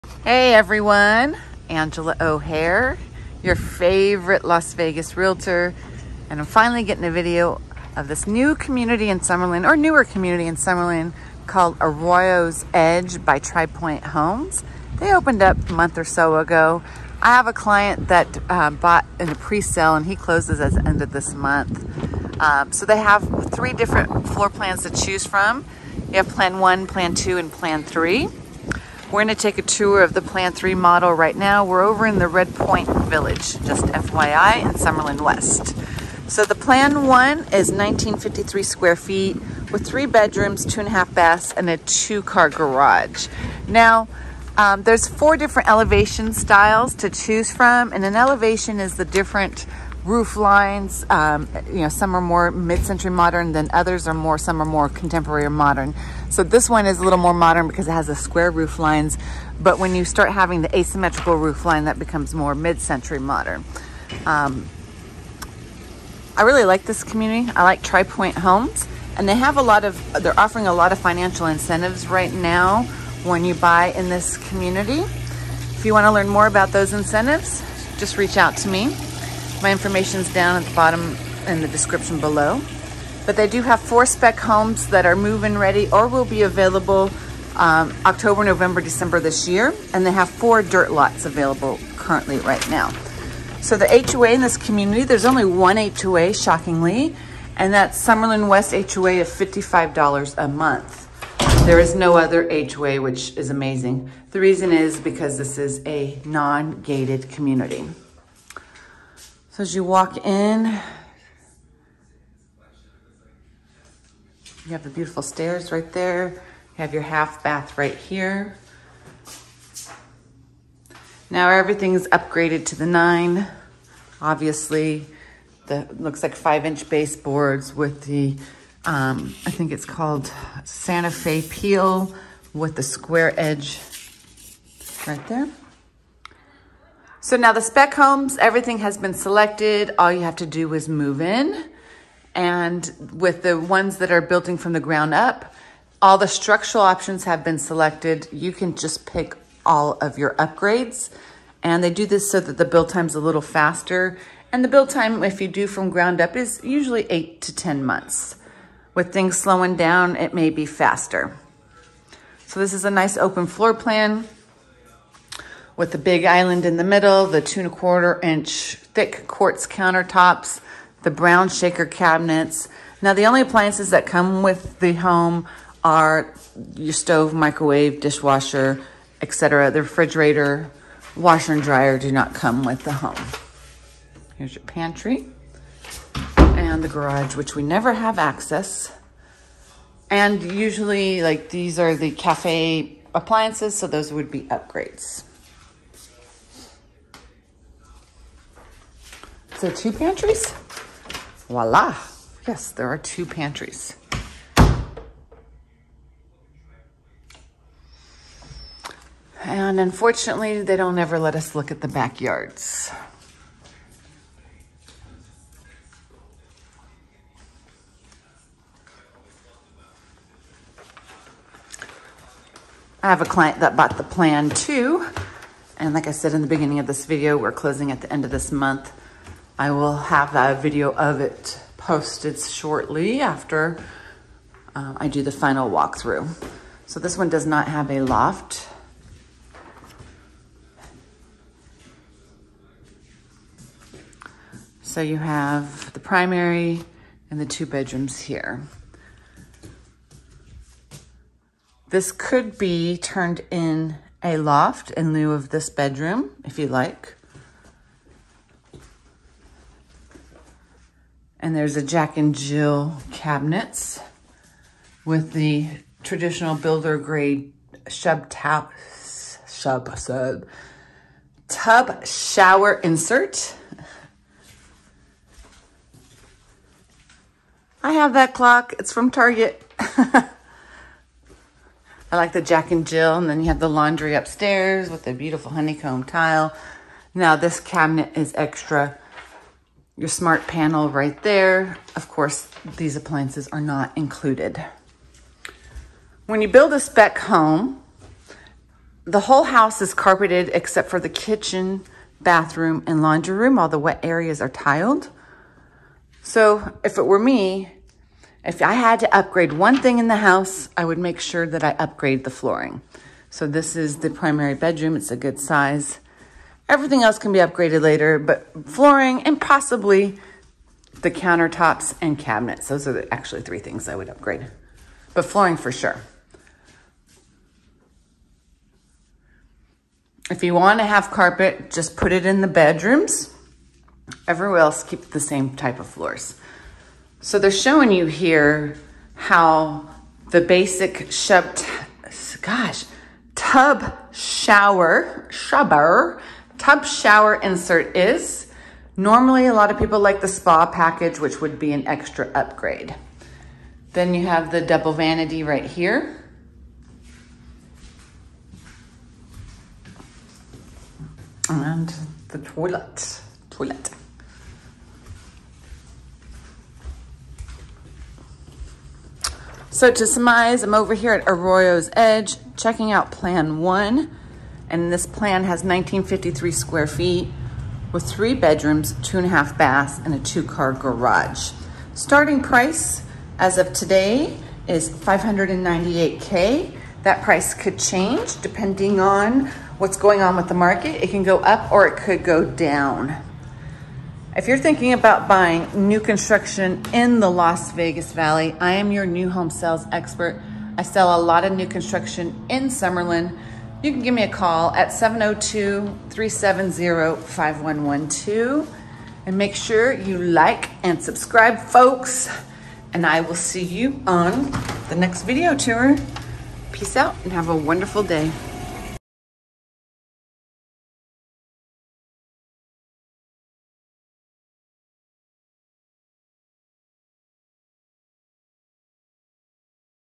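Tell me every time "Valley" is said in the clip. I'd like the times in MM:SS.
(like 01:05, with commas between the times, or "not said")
06:38.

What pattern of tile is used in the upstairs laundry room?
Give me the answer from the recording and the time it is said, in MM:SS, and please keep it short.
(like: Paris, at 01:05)
honeycomb, at 04:45.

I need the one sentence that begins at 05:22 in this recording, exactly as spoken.
Those are the, actually three things I would upgrade, but flooring for sure.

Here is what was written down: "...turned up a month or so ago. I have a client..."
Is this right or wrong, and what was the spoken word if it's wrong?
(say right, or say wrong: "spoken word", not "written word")
wrong: "opened", not "turned".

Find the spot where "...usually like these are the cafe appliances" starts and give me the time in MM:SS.
03:10.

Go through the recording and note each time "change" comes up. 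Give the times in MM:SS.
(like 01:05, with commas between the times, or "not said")
06:27.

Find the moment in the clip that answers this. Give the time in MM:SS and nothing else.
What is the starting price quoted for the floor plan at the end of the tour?
06:24.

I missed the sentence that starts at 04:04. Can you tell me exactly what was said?
So you have the primary and the two bedrooms here.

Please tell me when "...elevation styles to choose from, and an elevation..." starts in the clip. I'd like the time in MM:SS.
00:45.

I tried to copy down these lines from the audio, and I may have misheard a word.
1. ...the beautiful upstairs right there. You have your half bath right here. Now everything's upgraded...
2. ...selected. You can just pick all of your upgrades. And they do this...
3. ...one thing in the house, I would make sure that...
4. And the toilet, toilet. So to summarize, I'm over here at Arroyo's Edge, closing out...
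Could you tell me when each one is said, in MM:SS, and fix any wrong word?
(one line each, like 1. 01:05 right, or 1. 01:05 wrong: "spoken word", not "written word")
1. 01:54 wrong: "stairs", not "upstairs"
2. 02:27 right
3. 05:09 right
4. 06:01 wrong: "checking", not "closing".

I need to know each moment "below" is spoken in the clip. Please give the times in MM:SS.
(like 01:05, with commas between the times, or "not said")
01:22.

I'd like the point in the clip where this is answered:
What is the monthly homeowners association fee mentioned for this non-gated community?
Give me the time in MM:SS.
01:39.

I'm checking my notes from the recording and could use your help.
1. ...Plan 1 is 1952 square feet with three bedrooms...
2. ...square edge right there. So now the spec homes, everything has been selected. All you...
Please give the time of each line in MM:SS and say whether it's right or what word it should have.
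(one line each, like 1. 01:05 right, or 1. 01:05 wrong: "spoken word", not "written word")
1. 00:36 wrong: "1953", not "1952"
2. 02:12 right.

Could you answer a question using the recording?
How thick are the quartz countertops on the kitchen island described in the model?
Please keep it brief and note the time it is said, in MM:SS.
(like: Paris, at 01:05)
2 1/4 inch, at 02:47.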